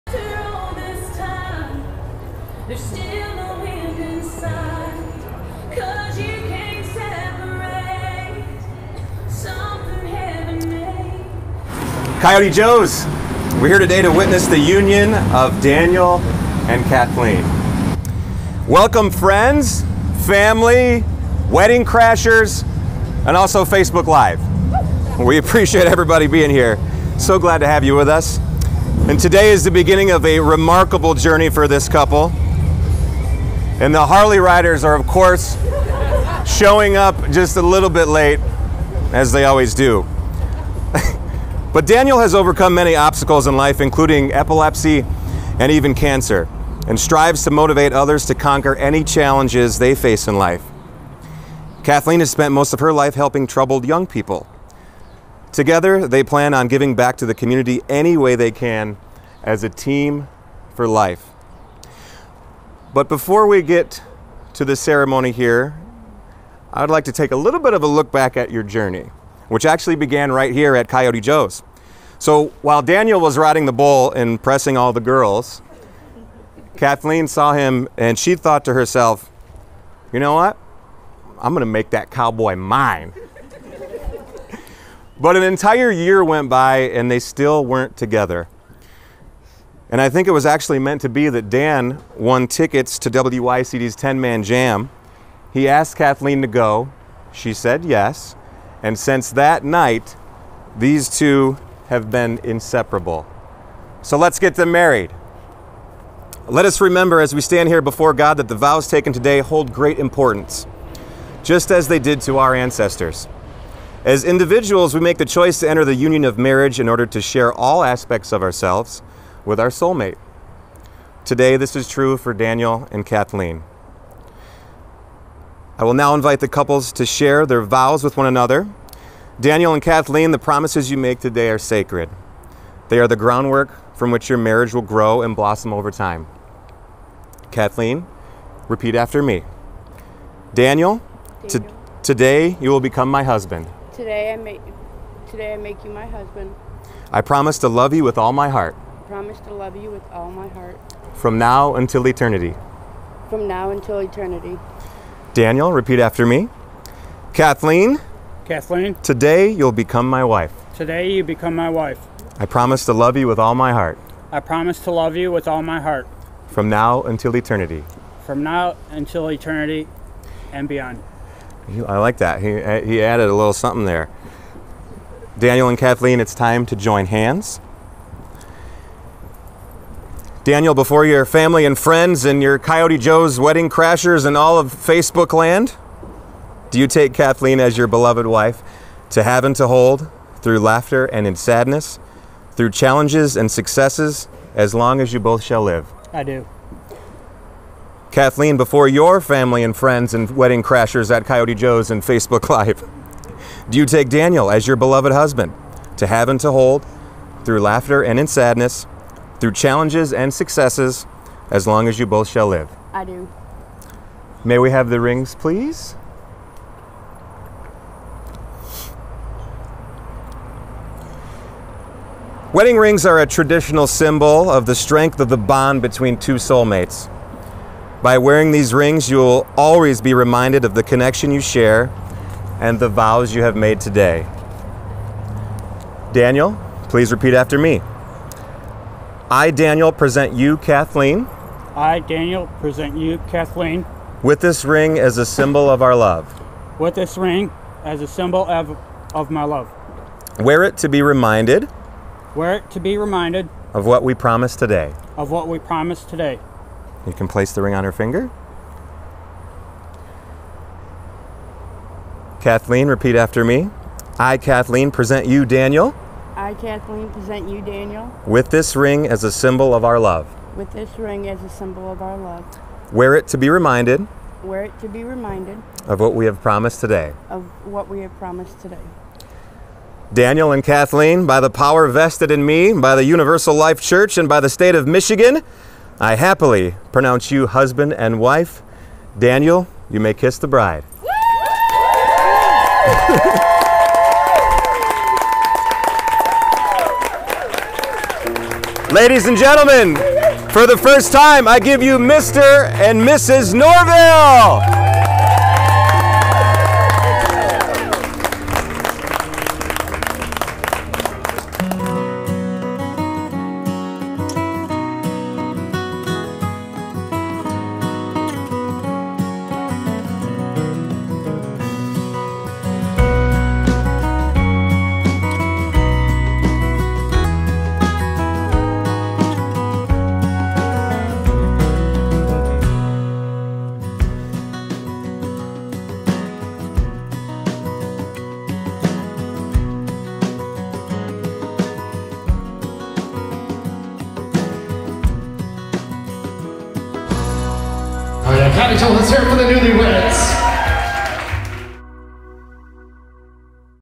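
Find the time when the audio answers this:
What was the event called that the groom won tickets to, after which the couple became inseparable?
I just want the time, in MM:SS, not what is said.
01:33.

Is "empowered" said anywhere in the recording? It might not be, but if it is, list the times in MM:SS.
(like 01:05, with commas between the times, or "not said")
not said.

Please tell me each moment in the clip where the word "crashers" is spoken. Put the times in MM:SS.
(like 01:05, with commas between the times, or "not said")
00:21, 03:03, 03:20.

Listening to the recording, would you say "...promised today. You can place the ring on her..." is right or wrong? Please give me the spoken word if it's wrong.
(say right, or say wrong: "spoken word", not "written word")
right.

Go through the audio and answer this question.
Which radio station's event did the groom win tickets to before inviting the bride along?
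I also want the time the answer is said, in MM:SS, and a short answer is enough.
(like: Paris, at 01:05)
WYCD, at 01:33.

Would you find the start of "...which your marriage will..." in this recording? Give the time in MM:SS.
02:14.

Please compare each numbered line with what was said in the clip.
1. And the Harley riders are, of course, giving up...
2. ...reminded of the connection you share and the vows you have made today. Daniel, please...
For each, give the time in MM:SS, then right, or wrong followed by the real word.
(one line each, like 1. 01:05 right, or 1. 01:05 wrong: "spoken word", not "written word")
1. 00:33 wrong: "showing", not "giving"
2. 03:50 right.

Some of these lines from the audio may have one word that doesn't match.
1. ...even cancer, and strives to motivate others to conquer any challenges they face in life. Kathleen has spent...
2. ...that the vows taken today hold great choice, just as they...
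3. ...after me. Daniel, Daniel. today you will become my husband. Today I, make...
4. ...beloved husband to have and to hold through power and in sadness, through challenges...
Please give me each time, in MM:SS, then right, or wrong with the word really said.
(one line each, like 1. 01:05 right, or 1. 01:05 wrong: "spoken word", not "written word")
1. 00:45 right
2. 01:48 wrong: "importance", not "choice"
3. 02:18 right
4. 03:24 wrong: "laughter", not "power".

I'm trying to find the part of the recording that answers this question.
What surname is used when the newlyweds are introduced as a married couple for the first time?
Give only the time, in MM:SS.
05:03.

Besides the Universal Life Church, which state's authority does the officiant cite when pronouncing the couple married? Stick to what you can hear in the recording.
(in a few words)
Michigan.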